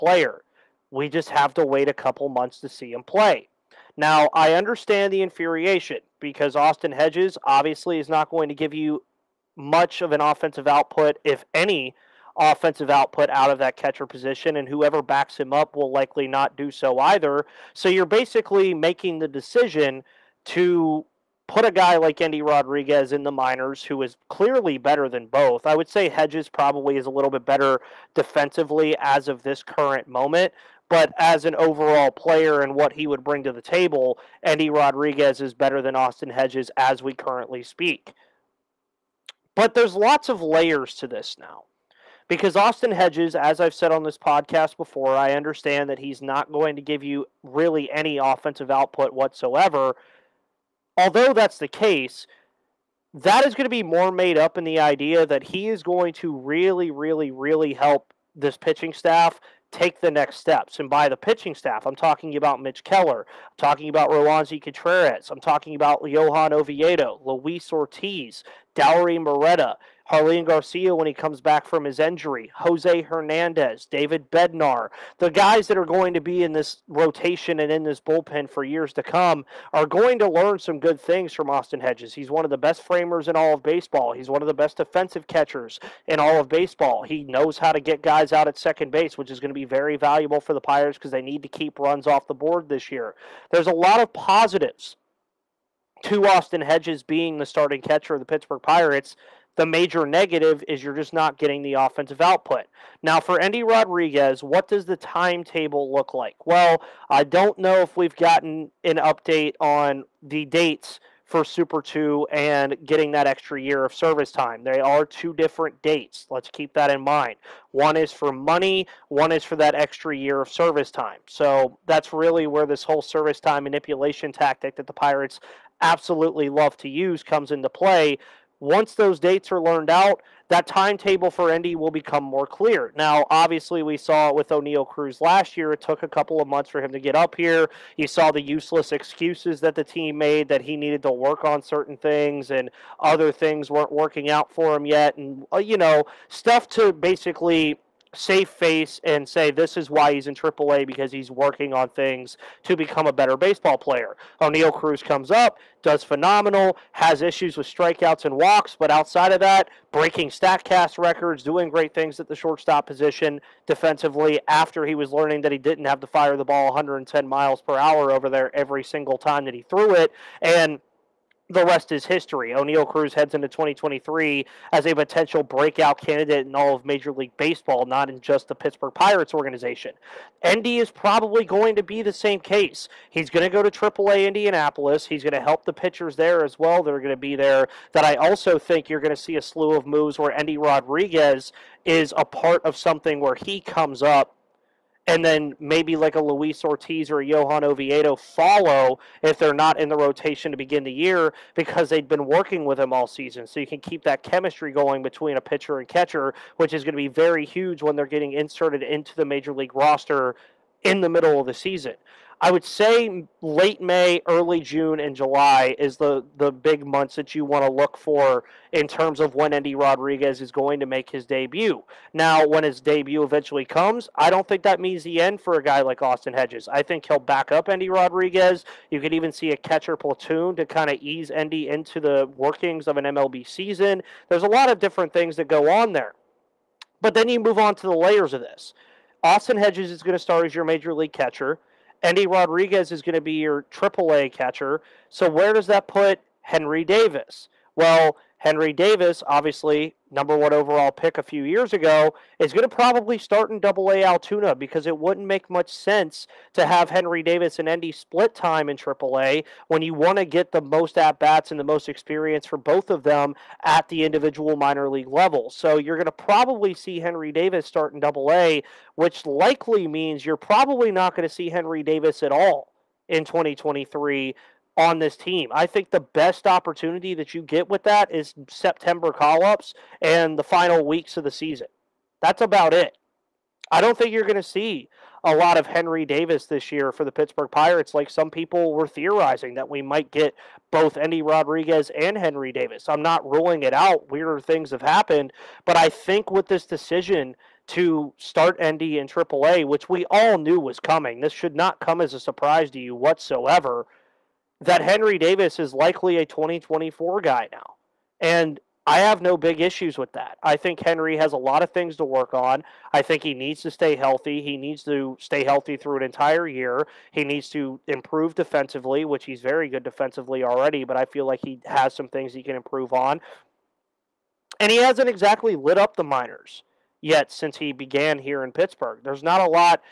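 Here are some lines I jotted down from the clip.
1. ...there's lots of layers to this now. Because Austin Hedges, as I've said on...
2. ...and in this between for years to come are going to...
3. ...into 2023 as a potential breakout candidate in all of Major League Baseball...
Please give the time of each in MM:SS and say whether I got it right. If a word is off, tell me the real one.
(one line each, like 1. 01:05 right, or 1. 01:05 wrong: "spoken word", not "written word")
1. 00:39 right
2. 01:17 wrong: "bullpen", not "between"
3. 02:53 right.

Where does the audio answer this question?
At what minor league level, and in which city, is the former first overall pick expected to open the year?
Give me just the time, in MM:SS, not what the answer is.
04:13.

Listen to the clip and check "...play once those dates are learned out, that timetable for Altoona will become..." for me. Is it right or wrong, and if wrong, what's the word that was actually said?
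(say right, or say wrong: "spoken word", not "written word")
wrong: "Endy", not "Altoona".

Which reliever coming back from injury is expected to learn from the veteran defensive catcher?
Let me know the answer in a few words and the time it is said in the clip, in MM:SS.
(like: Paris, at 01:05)
Jarlin Garcia, at 01:10.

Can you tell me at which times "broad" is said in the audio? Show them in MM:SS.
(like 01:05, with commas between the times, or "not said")
not said.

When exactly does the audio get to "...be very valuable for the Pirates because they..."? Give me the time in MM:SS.
01:29.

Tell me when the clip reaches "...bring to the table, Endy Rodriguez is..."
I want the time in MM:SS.
00:33.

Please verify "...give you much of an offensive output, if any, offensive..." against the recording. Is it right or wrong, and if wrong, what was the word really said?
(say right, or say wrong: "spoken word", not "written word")
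right.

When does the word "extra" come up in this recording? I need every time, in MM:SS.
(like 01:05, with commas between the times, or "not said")
01:53, 01:59.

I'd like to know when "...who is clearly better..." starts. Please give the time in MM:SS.
00:23.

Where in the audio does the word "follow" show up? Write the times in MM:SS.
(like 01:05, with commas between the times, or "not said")
03:18.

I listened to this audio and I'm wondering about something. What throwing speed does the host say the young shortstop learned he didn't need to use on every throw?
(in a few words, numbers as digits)
110 miles per hour.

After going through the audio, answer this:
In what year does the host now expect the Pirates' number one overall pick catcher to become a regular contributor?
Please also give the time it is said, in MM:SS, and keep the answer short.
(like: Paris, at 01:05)
2024, at 05:06.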